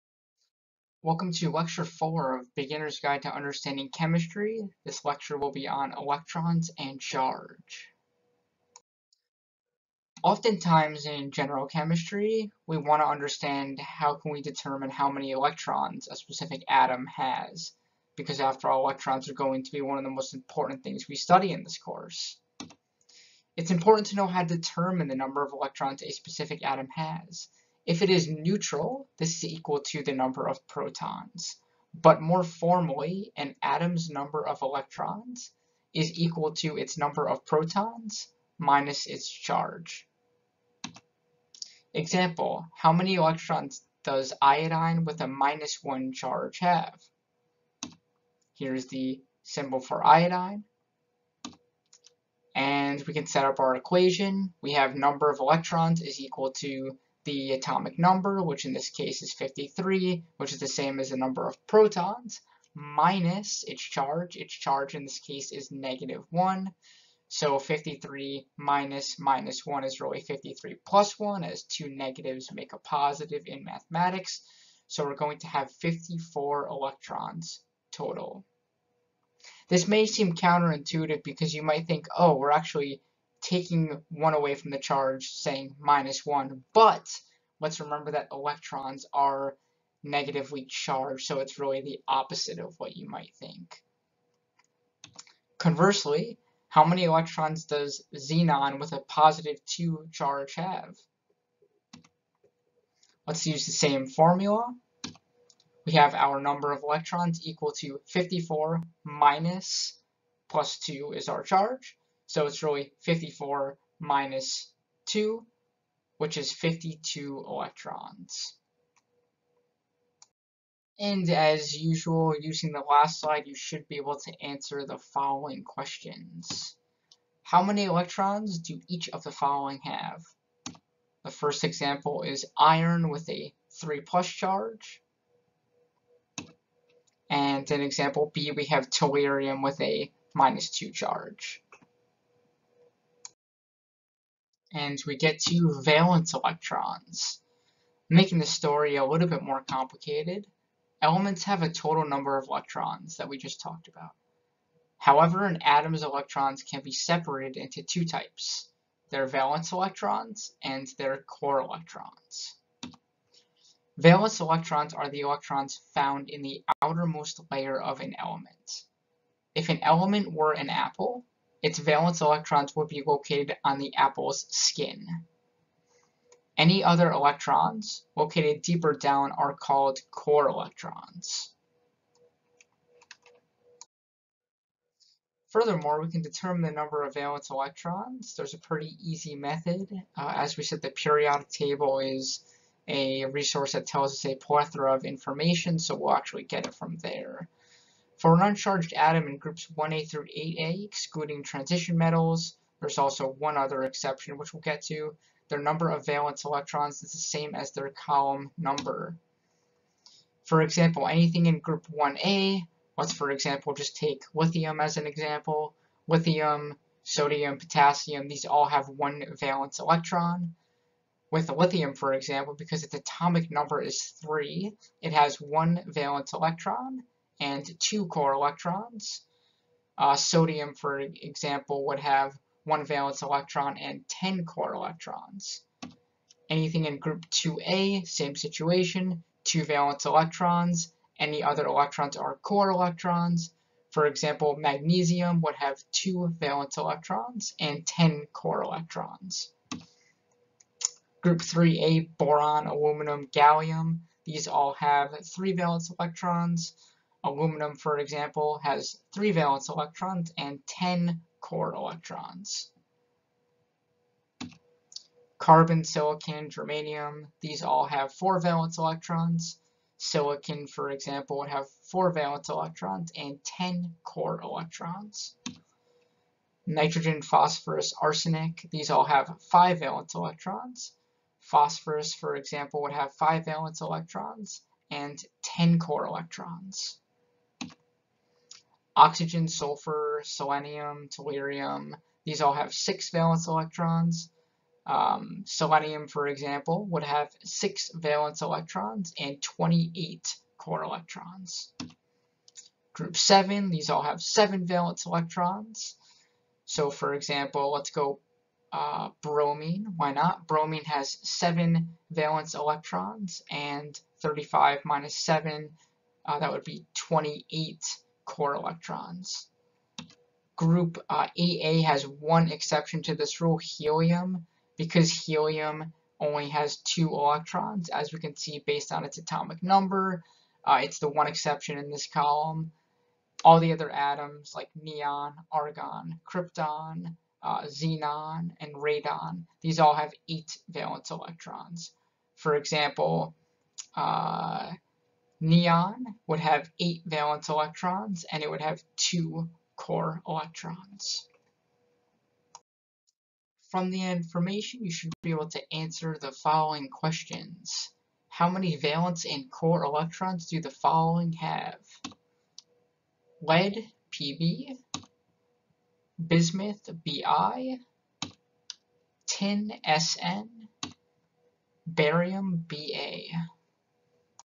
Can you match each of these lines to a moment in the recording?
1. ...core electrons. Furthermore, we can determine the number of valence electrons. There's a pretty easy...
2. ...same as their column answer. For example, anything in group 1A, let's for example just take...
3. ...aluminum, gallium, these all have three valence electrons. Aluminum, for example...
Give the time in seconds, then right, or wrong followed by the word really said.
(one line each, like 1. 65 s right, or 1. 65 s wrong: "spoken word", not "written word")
1. 180 s right
2. 207 s wrong: "number", not "answer"
3. 252 s right.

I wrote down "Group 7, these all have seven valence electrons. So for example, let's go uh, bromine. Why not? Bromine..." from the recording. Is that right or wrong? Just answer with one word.
right.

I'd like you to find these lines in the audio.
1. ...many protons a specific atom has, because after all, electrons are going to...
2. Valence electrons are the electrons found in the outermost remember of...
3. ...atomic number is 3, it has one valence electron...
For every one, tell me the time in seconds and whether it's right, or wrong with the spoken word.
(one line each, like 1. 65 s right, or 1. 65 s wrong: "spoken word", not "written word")
1. 15 s wrong: "electrons", not "protons"
2. 163 s wrong: "layer", not "remember"
3. 222 s right.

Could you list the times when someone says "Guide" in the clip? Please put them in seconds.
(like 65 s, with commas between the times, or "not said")
2 s.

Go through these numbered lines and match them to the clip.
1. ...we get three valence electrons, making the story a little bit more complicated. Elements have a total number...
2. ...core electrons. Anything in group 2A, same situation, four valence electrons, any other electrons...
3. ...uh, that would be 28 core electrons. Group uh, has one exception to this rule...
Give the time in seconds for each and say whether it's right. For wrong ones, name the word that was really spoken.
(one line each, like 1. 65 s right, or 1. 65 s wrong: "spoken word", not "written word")
1. 145 s wrong: "two", not "three"
2. 234 s wrong: "two", not "four"
3. 316 s right.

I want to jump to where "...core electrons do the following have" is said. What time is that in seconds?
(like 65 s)
359 s.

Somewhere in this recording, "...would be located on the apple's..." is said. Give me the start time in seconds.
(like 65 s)
172 s.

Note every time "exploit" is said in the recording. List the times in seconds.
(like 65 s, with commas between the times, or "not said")
not said.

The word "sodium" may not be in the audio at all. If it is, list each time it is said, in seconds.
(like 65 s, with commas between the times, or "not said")
217 s, 230 s.